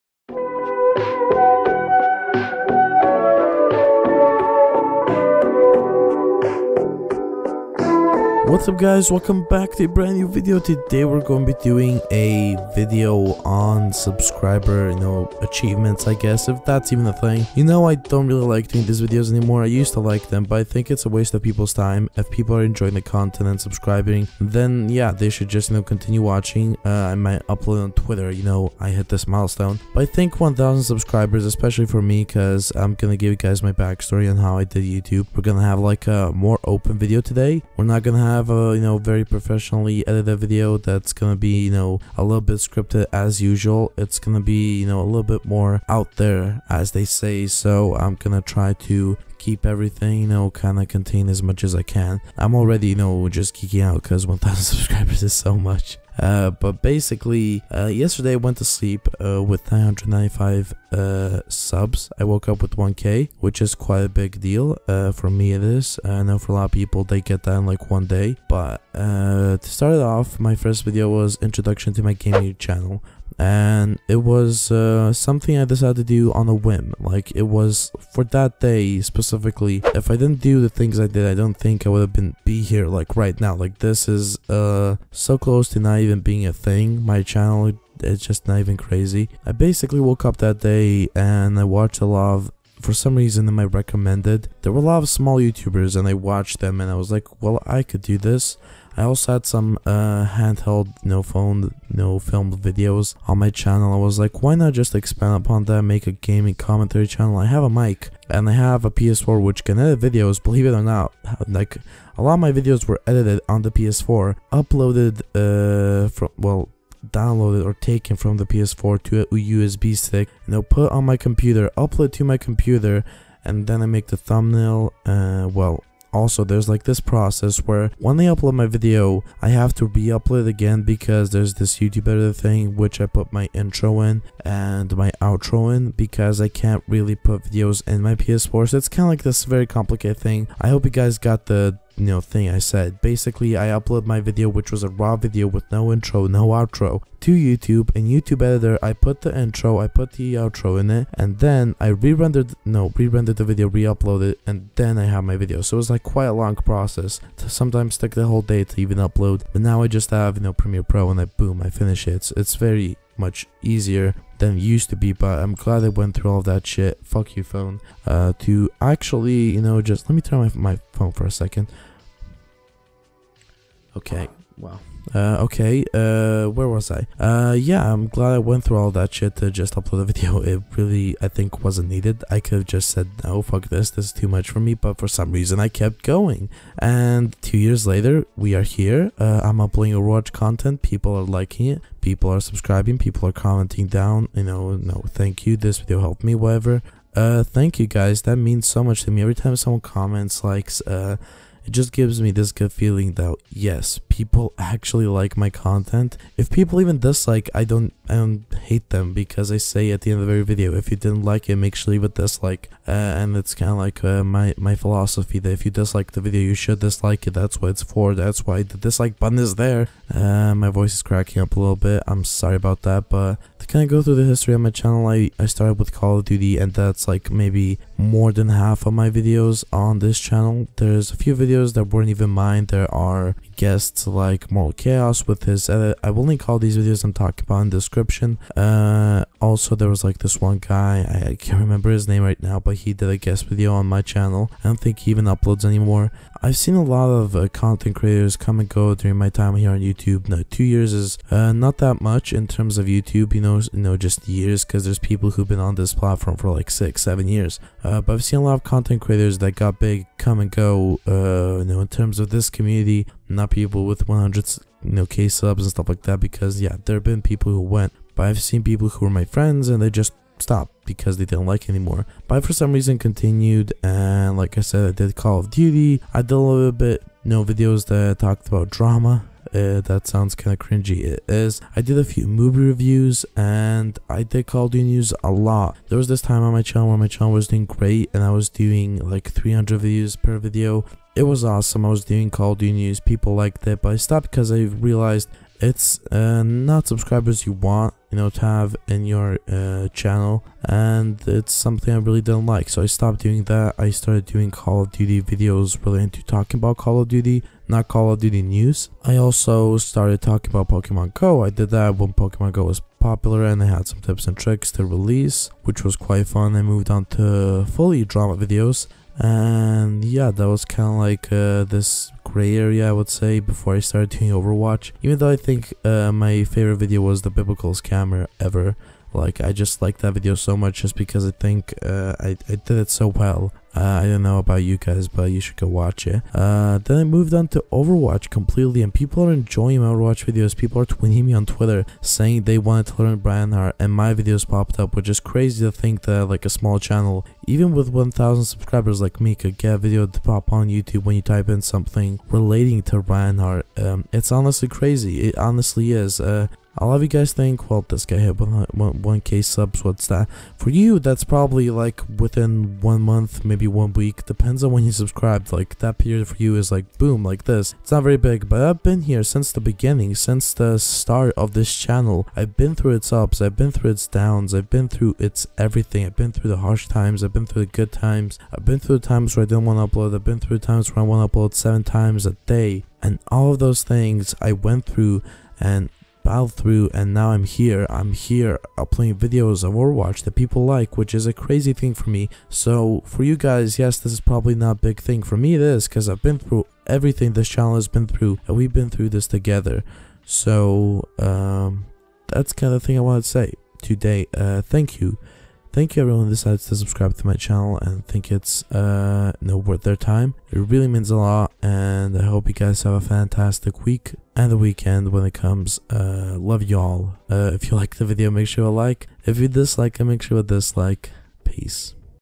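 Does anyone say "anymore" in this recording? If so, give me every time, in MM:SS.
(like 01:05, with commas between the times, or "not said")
00:19, 04:05, 04:31.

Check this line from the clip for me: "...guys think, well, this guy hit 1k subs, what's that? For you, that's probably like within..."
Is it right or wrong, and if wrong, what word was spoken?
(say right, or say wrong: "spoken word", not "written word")
right.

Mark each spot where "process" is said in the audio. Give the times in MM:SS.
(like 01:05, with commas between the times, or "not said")
02:06, 02:36.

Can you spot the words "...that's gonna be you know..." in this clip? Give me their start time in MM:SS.
00:40.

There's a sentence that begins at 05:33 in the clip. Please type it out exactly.
Uh, I don't know about you guys, but you should go watch it.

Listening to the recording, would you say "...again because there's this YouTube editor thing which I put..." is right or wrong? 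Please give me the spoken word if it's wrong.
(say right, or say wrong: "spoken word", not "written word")
right.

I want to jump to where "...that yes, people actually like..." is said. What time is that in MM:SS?
03:23.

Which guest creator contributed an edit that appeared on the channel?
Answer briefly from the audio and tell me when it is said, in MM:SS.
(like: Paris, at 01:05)
Moral Chaos, at 03:54.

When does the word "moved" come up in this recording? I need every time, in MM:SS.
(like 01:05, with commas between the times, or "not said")
05:16, 05:37.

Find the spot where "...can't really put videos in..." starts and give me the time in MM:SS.
02:16.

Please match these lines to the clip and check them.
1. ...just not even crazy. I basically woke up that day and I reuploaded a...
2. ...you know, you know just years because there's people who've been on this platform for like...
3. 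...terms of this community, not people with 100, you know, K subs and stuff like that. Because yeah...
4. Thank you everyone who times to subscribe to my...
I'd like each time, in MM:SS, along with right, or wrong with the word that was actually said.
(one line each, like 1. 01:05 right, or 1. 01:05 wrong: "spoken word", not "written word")
1. 01:28 wrong: "watched", not "reuploaded"
2. 04:13 right
3. 04:21 right
4. 06:45 wrong: "decides", not "times".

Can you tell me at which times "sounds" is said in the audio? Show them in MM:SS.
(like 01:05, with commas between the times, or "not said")
04:40.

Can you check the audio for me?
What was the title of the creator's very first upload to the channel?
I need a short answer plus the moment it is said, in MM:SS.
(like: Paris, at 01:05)
Introduction to my gaming channel, at 01:11.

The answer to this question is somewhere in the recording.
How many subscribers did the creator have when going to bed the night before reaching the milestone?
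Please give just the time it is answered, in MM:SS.
00:59.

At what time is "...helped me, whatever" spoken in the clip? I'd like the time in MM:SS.
03:16.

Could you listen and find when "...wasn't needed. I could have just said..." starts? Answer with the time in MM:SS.
03:01.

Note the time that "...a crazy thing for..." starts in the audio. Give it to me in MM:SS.
06:31.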